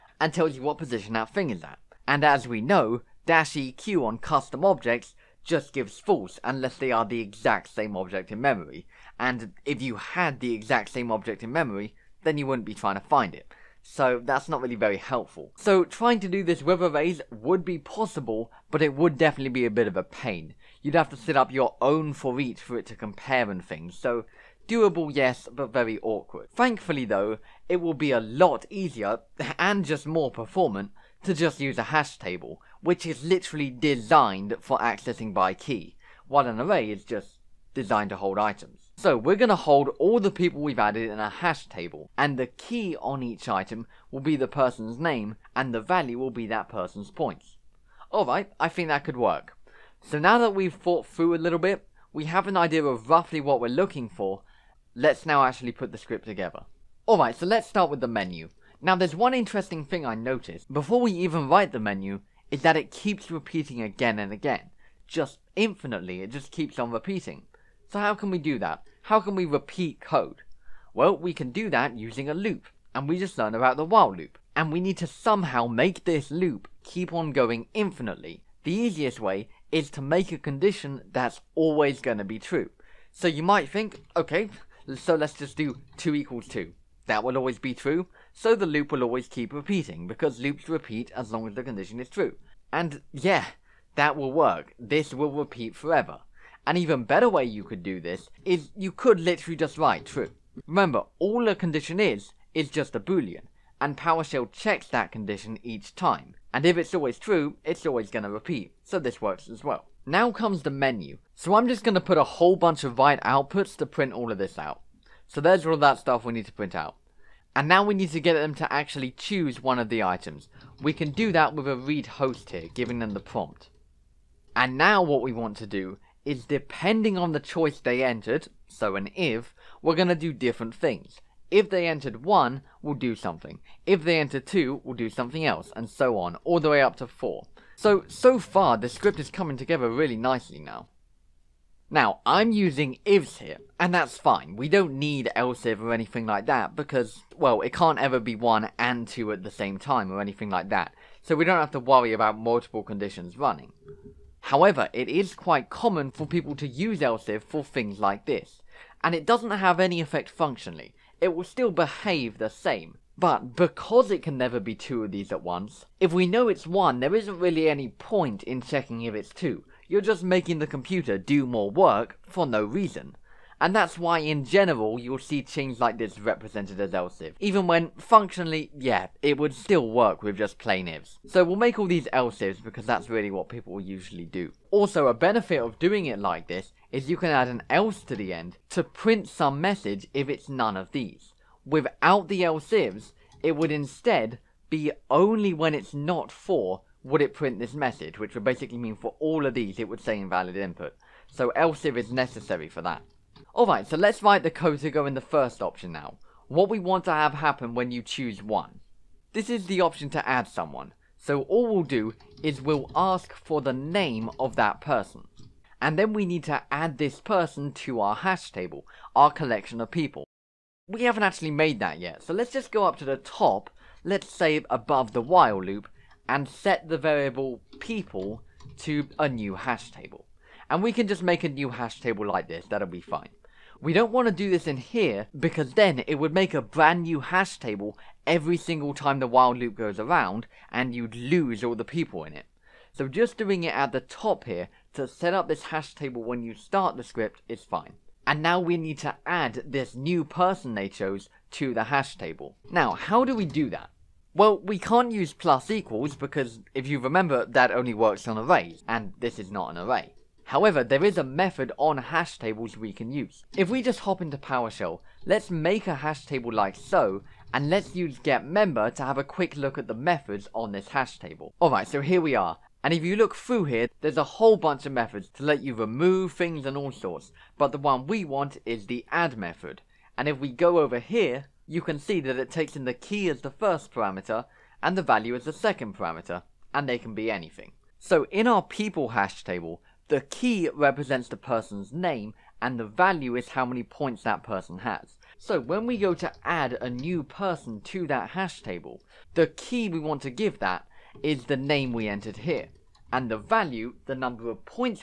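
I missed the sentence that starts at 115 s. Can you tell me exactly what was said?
So there's all that stuff we need to print out.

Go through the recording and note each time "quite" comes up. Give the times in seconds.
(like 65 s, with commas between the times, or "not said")
155 s.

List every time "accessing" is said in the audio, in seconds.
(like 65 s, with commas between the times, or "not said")
34 s.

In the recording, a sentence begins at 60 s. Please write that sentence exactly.
Before we even write the menu, is that it keeps repeating again and again.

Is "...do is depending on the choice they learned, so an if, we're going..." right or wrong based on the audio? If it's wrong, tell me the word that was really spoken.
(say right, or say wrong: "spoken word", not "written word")
wrong: "entered", not "learned".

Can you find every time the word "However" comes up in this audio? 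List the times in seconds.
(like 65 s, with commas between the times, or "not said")
154 s, 260 s.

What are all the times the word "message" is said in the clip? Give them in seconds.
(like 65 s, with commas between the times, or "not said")
189 s, 197 s.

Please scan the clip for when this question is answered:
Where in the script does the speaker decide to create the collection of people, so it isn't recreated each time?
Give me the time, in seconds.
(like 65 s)
224 s.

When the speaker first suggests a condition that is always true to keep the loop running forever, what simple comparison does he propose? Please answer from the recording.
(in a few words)
2 equals 2.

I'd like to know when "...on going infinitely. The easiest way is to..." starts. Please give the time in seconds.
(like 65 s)
77 s.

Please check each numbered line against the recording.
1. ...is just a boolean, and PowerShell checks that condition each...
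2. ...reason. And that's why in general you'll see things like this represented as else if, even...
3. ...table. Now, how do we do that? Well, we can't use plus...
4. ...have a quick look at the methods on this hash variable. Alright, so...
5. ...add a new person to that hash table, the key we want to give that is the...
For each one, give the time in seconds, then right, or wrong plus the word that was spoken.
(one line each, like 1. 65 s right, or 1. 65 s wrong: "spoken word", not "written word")
1. 102 s right
2. 172 s right
3. 252 s right
4. 269 s wrong: "table", not "variable"
5. 296 s right.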